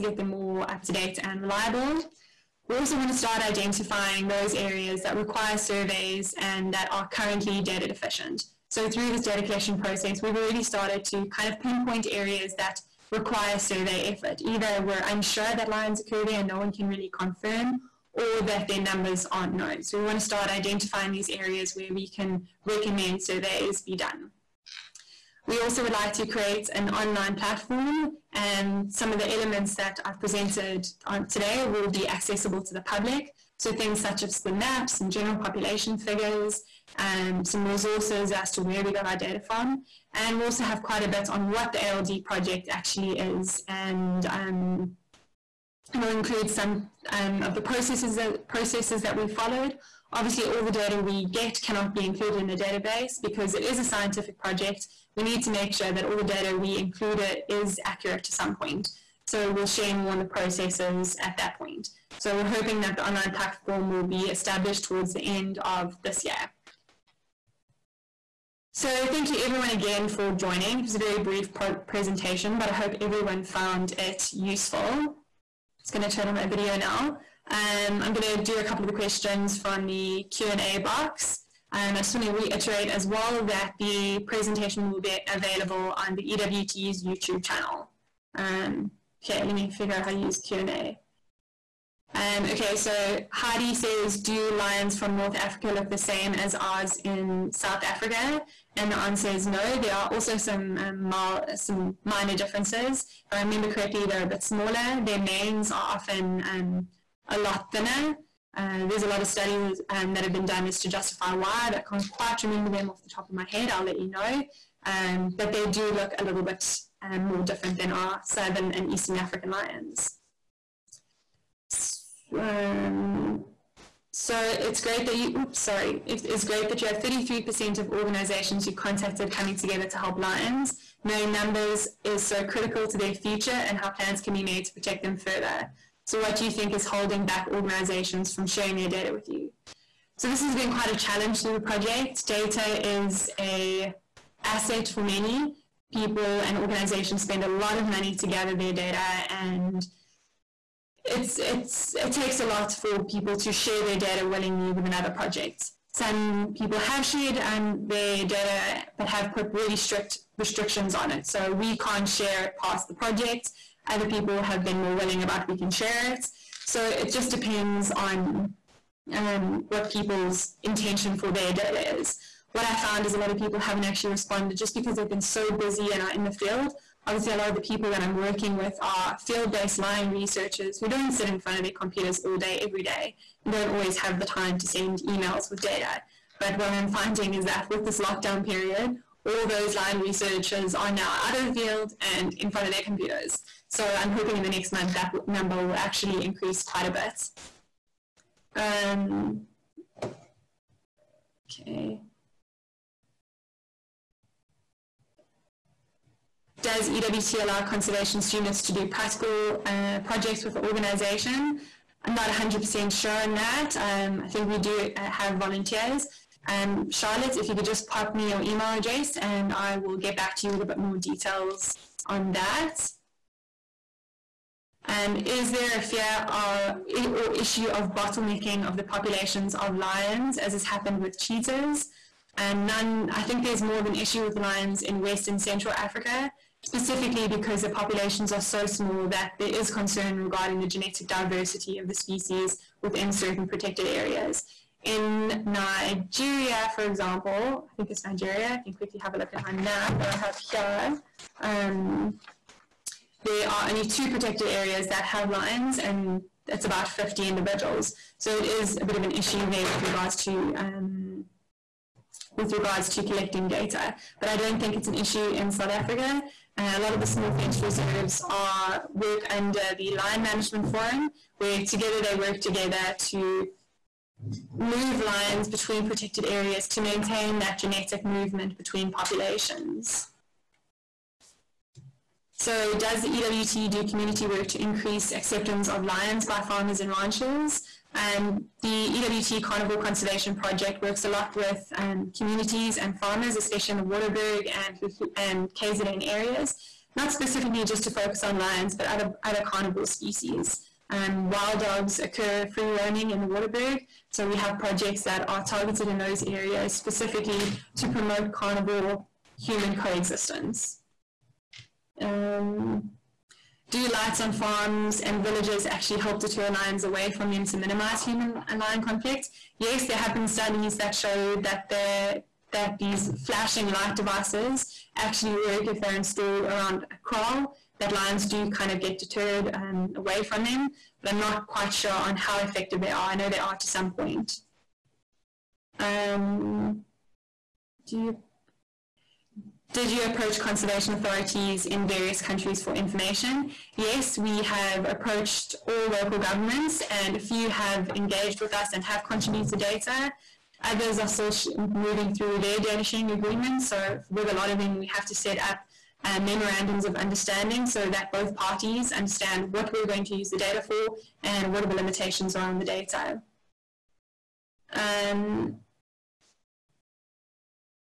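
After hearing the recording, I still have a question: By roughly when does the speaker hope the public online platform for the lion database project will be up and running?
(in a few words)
end of this year.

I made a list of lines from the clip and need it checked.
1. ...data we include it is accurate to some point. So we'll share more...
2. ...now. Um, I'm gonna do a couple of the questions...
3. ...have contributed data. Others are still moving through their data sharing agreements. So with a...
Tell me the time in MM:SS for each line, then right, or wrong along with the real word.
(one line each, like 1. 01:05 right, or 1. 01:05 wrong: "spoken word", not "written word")
1. 00:56 right
2. 01:16 right
3. 05:48 right.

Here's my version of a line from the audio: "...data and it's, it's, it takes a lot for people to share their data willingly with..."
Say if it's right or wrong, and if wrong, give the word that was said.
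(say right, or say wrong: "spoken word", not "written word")
right.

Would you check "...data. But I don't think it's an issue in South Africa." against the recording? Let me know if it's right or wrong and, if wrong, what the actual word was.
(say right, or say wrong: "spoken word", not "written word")
right.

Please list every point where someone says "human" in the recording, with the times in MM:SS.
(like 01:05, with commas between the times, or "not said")
05:09, 05:18.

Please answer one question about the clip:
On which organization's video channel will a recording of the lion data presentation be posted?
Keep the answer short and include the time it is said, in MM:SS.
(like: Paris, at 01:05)
EWT's YouTube channel, at 01:26.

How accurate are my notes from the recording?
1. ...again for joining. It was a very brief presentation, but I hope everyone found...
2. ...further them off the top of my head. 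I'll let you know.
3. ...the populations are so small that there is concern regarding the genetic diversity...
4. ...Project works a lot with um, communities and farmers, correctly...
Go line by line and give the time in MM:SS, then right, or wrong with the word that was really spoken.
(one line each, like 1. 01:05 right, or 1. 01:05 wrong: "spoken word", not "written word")
1. 01:09 right
2. 01:52 wrong: "remember", not "further"
3. 03:57 right
4. 04:50 wrong: "especially", not "correctly".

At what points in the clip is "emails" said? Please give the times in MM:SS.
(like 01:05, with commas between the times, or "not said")
03:05, 03:38.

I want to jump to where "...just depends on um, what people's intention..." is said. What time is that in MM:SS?
02:47.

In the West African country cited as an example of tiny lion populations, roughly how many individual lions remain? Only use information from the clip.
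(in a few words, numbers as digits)
50.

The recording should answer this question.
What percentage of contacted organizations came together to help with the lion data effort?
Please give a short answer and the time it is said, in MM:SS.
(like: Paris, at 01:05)
33%, at 02:06.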